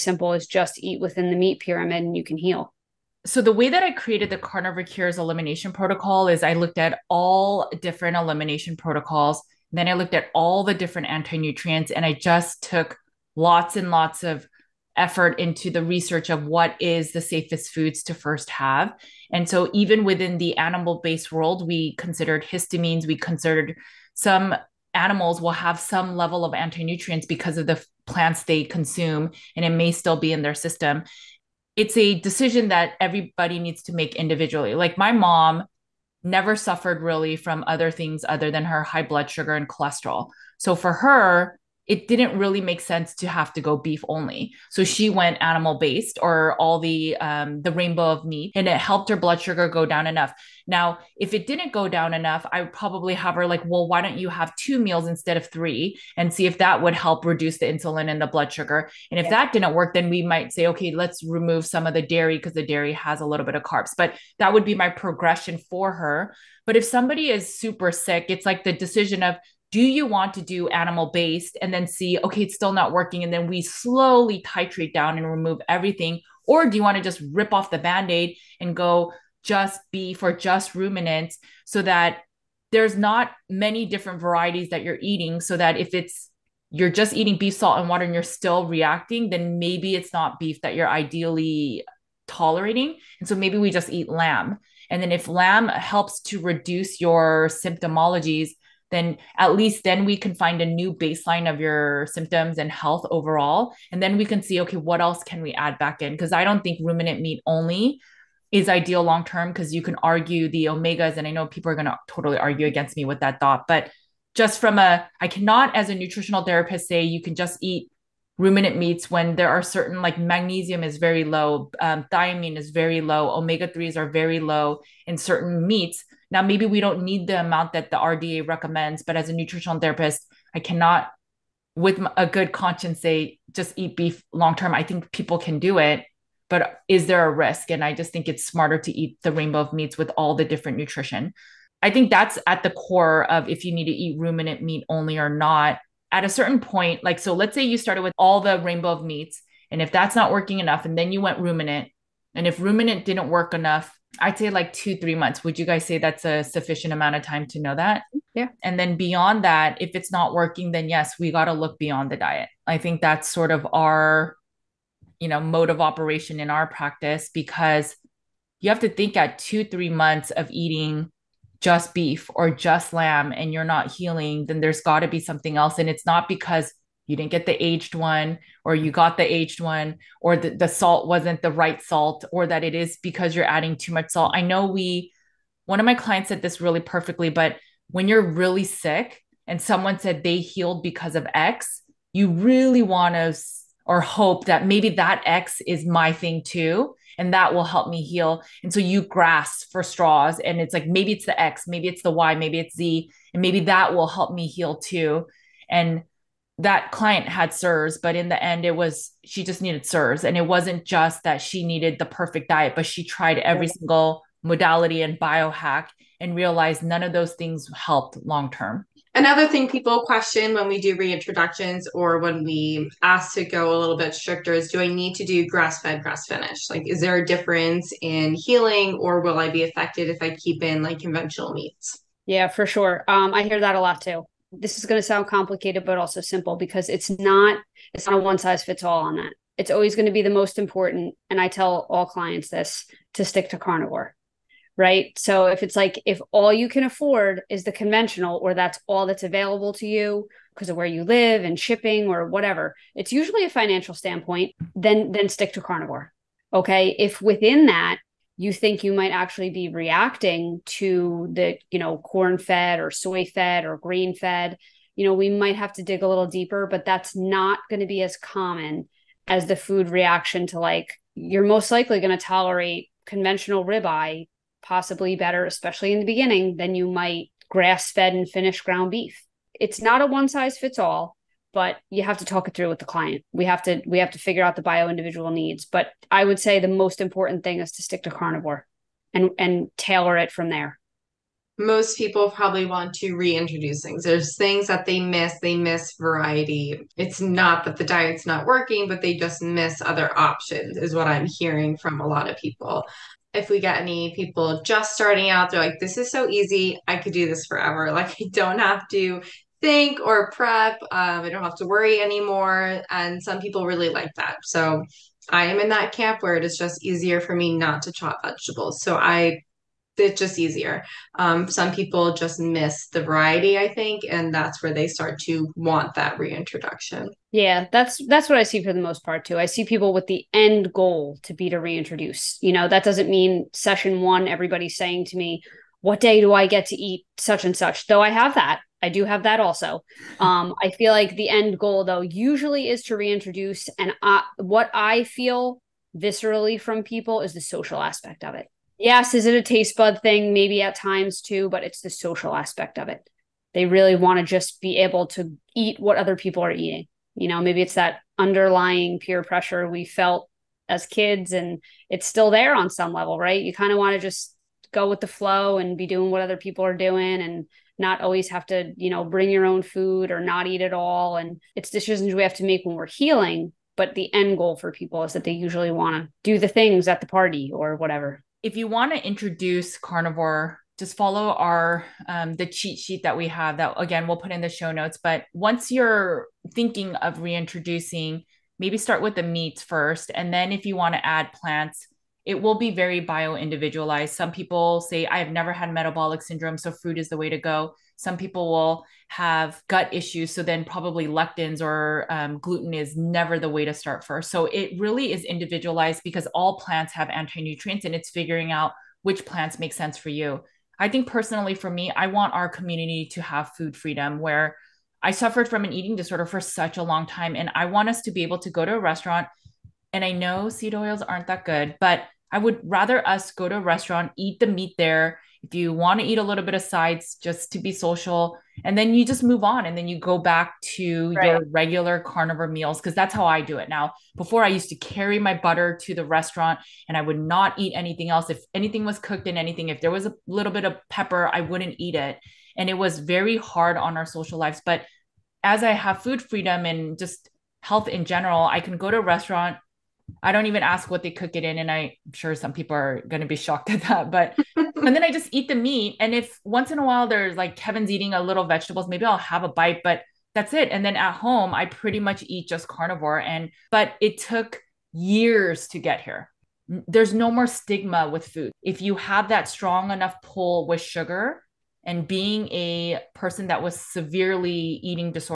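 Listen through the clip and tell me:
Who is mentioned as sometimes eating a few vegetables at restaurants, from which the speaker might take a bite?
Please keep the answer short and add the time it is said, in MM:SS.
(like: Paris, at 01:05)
Kevin, at 07:37.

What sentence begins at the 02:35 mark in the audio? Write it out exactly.
Would you guys say that's a sufficient amount of time to know that?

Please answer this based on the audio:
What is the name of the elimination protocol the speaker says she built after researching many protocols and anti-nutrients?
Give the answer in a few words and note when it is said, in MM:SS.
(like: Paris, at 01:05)
Carnivore Cures elimination protocol, at 00:04.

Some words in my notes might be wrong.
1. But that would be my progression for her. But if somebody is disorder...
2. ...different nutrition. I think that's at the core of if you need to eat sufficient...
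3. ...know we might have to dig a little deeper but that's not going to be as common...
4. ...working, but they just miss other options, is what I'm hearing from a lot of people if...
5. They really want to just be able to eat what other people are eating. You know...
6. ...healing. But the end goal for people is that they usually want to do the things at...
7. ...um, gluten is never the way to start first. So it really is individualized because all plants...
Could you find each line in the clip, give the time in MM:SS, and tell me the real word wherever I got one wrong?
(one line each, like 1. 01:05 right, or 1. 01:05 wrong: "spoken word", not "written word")
1. 01:03 wrong: "super", not "disorder"
2. 02:20 wrong: "ruminant", not "sufficient"
3. 04:25 right
4. 04:58 right
5. 05:53 right
6. 06:12 right
7. 06:42 right.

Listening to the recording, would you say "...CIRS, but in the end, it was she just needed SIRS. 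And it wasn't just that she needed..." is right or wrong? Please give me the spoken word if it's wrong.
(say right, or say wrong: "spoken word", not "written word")
right.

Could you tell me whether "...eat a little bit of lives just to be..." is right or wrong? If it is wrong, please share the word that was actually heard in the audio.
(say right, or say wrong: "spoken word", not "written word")
wrong: "sides", not "lives".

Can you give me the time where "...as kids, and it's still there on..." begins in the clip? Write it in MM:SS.
06:00.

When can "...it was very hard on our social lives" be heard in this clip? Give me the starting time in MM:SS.
07:22.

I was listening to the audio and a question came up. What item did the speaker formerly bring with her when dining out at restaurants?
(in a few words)
butter.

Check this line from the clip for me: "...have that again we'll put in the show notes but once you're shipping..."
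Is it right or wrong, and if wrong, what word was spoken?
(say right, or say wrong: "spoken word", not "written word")
wrong: "thinking", not "shipping".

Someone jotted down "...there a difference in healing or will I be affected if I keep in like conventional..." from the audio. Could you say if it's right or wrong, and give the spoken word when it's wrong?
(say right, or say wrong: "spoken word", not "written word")
right.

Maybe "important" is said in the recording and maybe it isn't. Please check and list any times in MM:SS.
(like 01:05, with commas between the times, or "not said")
04:00, 04:47.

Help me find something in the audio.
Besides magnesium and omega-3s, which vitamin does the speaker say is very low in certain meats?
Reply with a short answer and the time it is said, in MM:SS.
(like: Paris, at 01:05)
thiamine, at 02:02.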